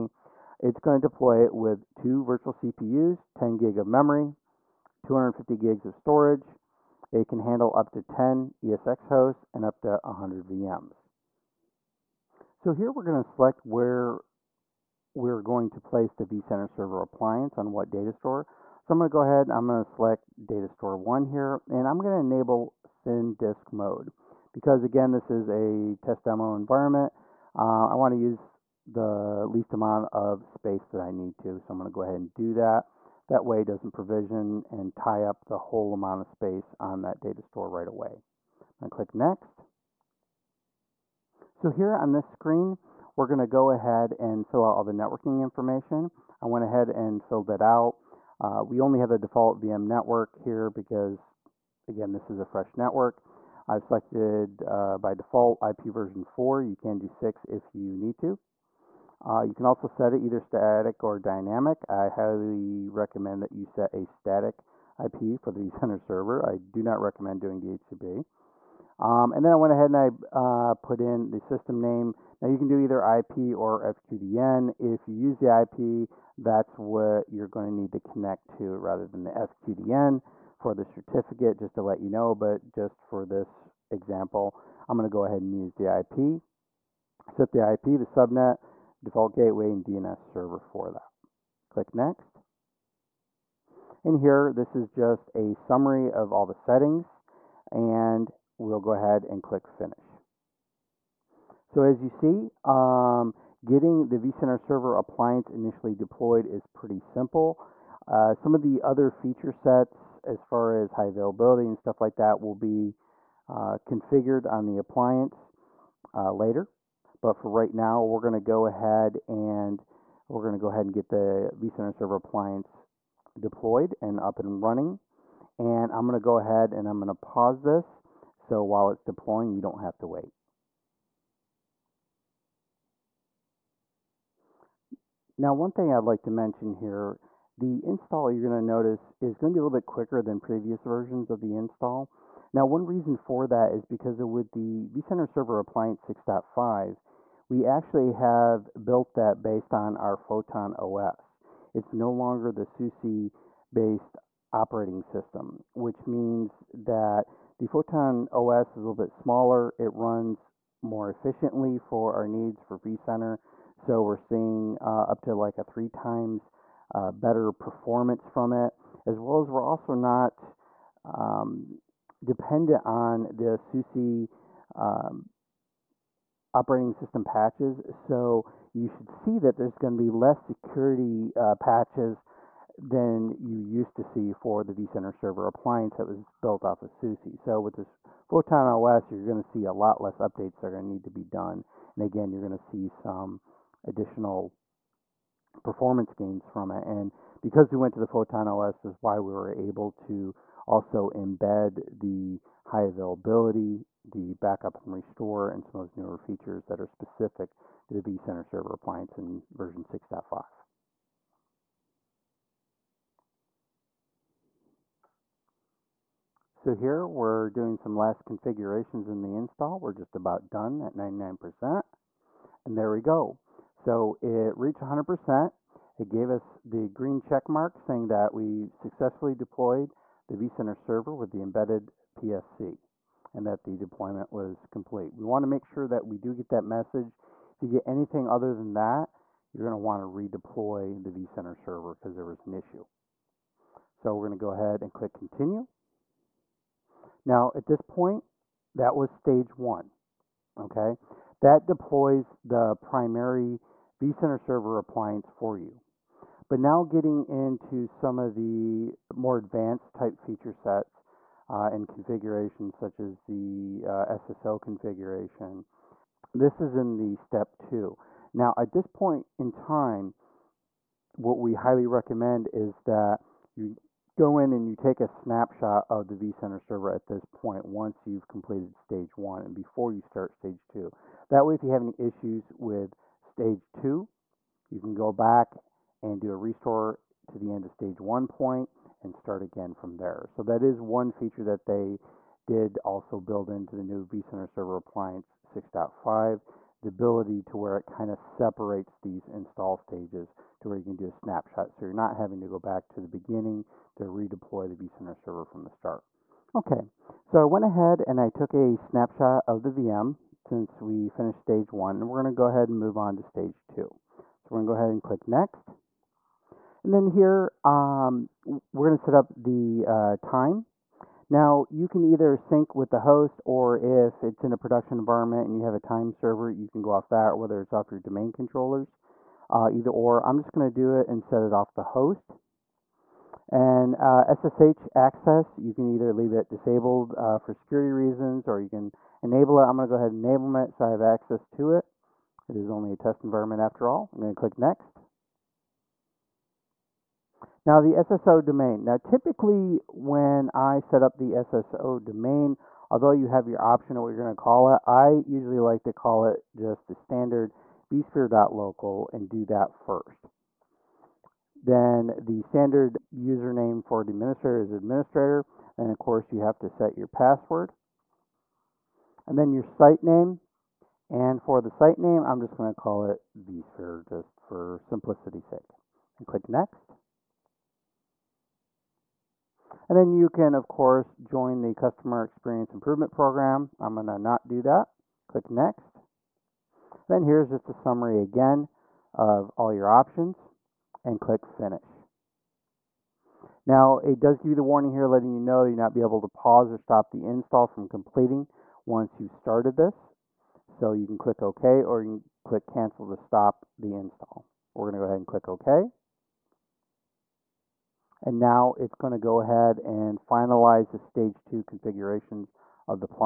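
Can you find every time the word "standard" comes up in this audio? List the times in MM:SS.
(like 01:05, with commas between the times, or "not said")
05:56, 06:02.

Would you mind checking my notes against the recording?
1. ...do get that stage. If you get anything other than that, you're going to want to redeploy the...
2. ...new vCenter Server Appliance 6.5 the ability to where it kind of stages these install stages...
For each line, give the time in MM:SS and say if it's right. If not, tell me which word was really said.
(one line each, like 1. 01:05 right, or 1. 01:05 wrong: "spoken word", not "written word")
1. 03:56 wrong: "message", not "stage"
2. 04:53 wrong: "separates", not "stages".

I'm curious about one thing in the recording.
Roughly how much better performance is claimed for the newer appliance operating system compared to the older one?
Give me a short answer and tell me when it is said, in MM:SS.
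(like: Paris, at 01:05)
3 times, at 02:45.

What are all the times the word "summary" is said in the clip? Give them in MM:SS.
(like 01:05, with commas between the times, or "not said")
01:35, 06:27.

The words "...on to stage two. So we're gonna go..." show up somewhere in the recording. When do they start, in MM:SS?
05:12.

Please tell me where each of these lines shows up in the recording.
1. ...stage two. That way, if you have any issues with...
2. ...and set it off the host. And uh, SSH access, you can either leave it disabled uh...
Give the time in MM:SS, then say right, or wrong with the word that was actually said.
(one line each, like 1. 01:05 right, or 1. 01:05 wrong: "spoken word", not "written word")
1. 04:40 right
2. 05:31 right.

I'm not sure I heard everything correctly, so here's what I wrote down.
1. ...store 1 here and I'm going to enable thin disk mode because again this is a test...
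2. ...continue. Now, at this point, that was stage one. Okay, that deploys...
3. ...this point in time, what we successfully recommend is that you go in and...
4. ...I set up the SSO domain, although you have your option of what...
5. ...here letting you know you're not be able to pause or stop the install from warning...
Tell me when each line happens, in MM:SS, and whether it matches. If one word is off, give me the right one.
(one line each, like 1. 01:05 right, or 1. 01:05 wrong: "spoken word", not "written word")
1. 00:20 right
2. 04:05 right
3. 04:28 wrong: "highly", not "successfully"
4. 05:50 right
5. 06:34 wrong: "completing", not "warning".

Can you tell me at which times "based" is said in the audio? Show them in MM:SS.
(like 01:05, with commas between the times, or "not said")
02:29, 02:33.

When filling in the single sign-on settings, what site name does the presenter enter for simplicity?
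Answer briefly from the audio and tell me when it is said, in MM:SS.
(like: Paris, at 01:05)
vSphere, at 06:13.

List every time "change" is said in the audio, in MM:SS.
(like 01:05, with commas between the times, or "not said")
not said.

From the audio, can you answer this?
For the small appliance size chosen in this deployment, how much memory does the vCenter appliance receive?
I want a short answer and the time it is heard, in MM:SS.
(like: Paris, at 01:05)
10 GB, at 00:03.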